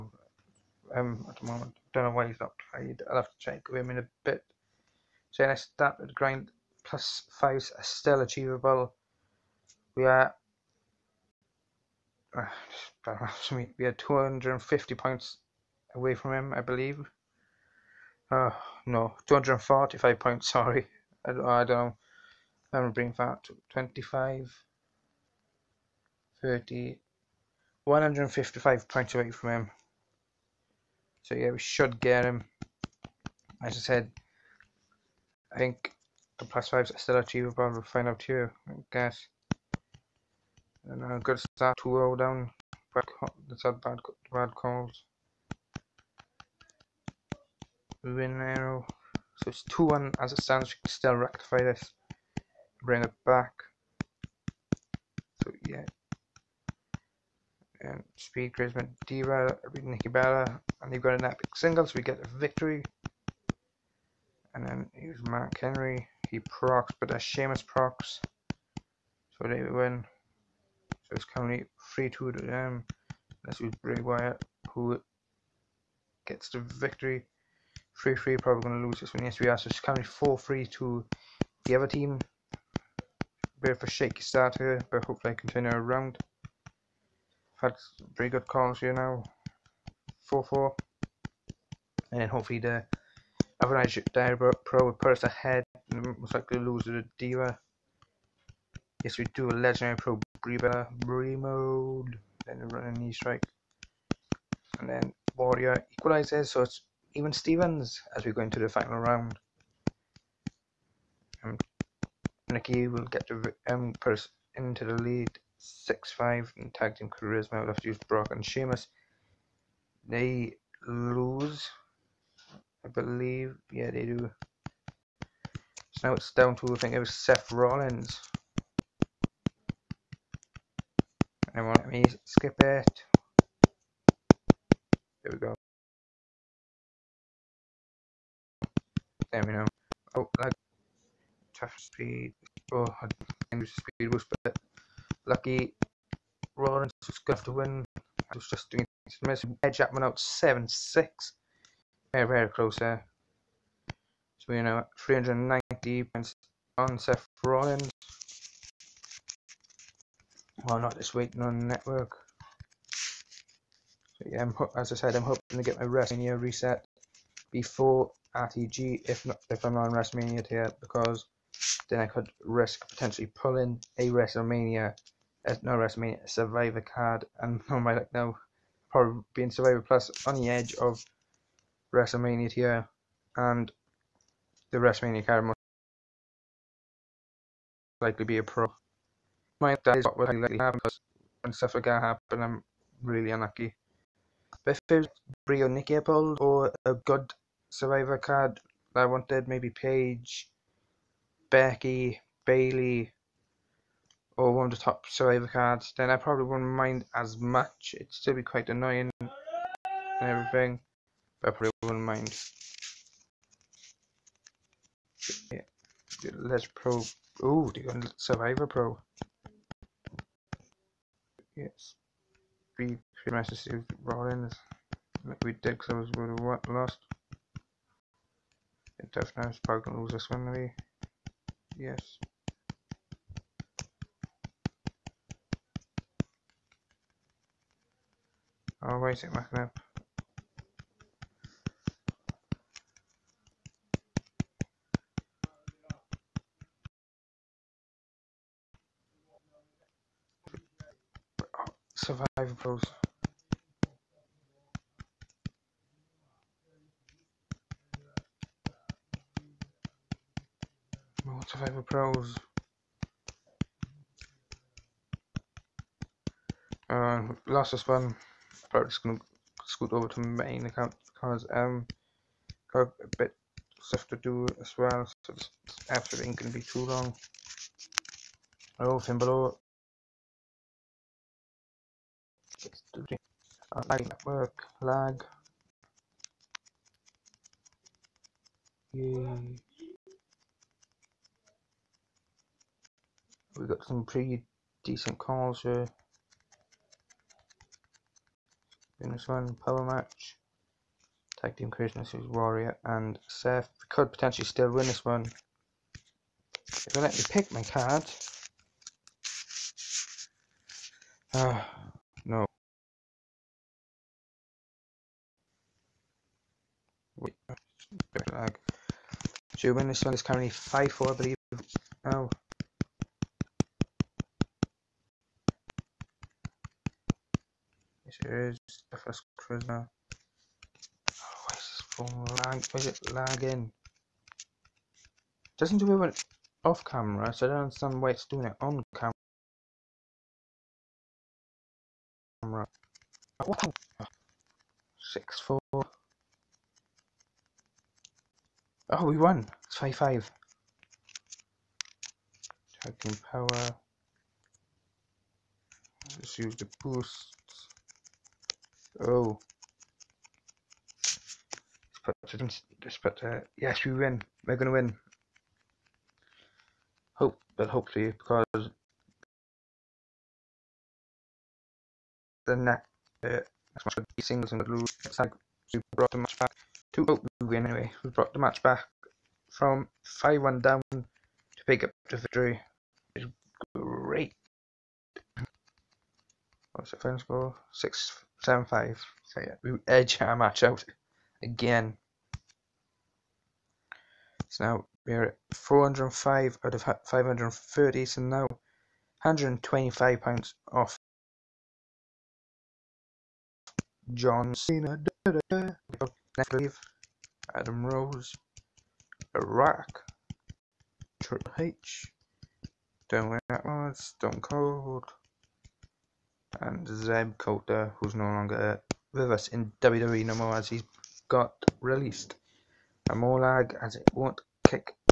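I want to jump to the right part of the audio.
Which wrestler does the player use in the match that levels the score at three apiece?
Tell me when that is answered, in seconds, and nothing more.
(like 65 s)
73 s.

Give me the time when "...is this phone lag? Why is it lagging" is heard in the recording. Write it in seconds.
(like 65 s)
331 s.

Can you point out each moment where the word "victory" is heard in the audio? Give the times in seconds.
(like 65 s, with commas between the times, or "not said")
62 s, 76 s, 382 s.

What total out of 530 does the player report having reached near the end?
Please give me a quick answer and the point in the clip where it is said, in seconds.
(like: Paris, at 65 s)
405, at 395 s.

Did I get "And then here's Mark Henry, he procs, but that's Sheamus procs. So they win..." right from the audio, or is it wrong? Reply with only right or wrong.
right.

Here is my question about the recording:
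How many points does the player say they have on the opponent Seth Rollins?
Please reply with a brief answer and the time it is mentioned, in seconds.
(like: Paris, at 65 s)
390, at 154 s.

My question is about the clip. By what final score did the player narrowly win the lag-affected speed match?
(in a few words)
7 6.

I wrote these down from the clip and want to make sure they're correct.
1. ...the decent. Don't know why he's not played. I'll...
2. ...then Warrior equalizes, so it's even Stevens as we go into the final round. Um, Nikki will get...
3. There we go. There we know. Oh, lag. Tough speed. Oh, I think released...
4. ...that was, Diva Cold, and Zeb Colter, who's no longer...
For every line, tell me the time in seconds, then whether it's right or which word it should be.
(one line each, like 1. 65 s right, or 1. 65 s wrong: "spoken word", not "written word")
1. 1 s wrong: "moment", not "decent"
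2. 104 s right
3. 135 s wrong: "speed", not "released"
4. 413 s wrong: "Stone", not "Diva".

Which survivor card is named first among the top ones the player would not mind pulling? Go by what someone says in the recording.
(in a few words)
Paige.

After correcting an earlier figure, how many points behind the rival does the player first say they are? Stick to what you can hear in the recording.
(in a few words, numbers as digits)
245.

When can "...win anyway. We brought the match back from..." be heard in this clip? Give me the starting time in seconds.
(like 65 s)
377 s.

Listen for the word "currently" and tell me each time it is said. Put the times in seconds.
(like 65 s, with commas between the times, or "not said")
71 s, 79 s, 320 s.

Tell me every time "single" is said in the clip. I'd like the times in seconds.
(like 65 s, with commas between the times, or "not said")
61 s, 374 s.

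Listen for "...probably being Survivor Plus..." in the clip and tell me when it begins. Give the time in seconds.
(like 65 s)
178 s.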